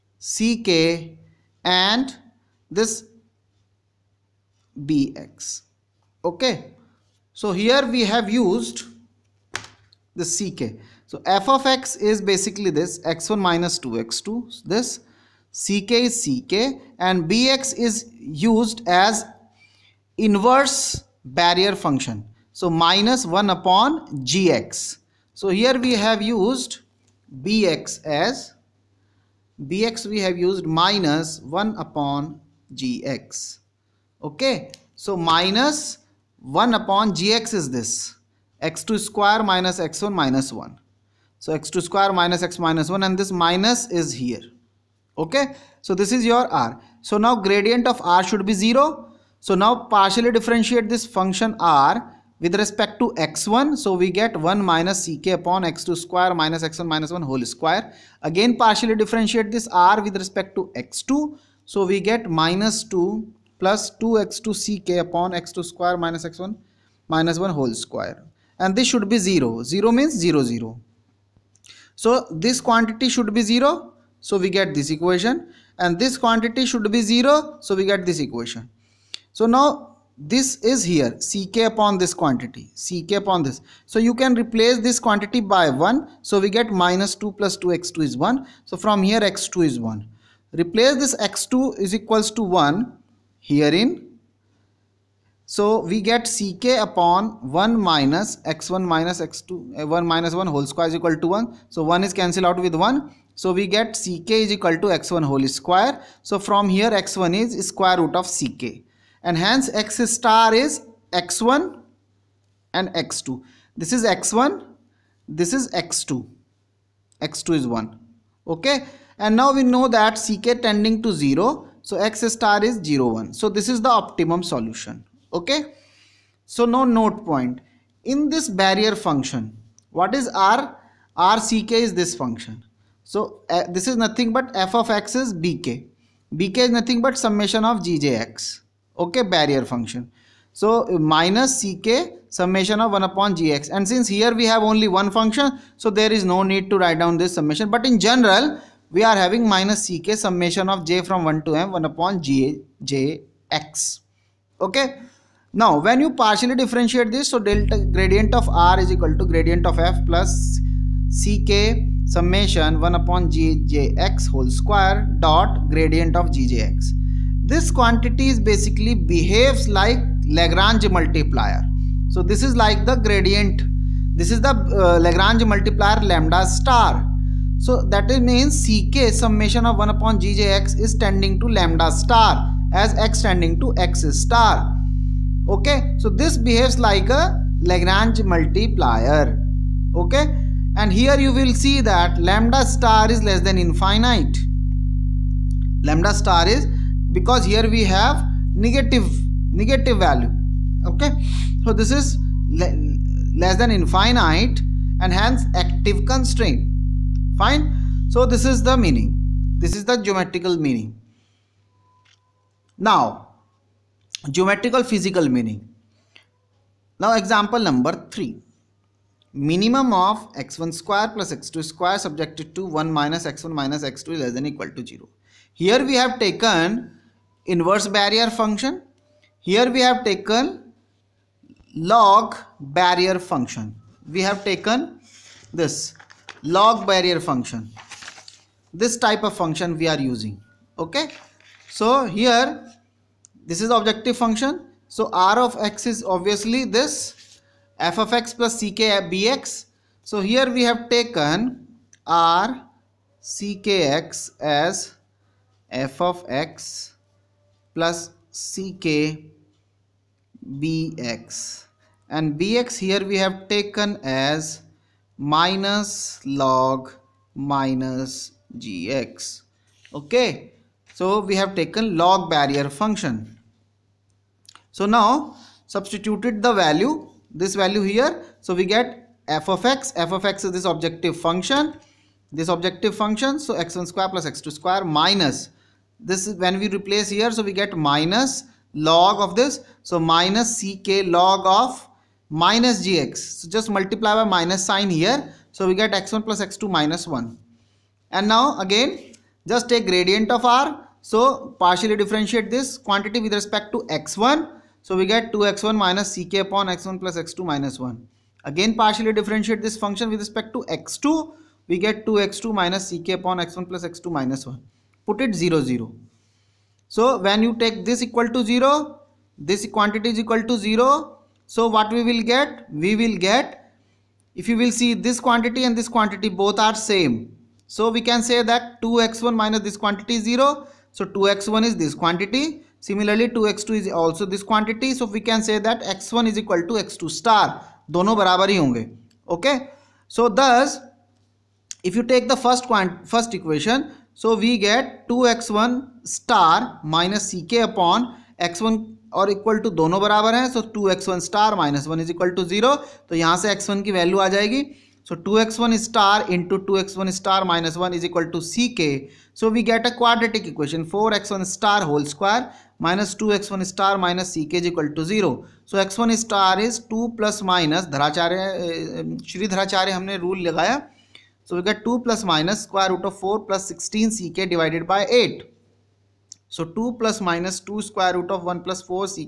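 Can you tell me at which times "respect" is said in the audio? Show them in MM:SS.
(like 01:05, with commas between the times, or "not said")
00:52, 01:00, 05:03, 05:10.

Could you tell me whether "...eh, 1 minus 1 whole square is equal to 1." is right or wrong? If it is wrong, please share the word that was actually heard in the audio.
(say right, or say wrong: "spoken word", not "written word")
right.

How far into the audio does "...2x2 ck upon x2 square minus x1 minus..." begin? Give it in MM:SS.
01:03.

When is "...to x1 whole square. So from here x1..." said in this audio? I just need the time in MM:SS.
01:44.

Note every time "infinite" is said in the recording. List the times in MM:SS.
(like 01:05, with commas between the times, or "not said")
03:13, 03:23.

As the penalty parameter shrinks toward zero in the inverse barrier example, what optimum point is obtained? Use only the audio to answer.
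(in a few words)
(0, 1).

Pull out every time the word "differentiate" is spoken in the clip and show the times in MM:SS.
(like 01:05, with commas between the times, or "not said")
00:50, 00:58, 02:36, 05:01, 05:09.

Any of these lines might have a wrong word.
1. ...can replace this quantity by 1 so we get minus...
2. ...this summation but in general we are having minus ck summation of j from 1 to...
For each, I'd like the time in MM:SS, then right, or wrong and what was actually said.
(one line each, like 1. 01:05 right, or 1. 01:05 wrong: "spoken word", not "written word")
1. 01:24 right
2. 02:27 right.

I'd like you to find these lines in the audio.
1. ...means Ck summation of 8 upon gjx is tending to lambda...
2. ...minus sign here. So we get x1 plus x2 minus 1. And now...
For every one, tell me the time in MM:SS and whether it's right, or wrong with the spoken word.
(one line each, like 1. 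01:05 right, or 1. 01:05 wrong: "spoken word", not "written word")
1. 02:58 wrong: "1", not "8"
2. 04:54 right.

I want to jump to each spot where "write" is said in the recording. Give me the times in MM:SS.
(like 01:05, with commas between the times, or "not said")
02:26.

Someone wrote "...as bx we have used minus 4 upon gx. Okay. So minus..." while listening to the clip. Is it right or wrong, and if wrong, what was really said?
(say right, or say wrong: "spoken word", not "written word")
wrong: "1", not "4".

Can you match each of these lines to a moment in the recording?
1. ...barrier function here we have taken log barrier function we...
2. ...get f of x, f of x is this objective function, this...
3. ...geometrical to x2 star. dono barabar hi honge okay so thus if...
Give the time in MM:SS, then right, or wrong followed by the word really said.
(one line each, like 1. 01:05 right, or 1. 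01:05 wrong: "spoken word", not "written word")
1. 03:47 right
2. 04:38 right
3. 05:36 wrong: "equal", not "geometrical".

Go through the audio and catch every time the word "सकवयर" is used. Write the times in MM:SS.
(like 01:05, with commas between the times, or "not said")
06:02, 06:12, 06:17.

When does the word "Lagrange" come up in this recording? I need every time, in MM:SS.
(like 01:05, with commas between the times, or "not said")
02:50, 02:54, 03:07.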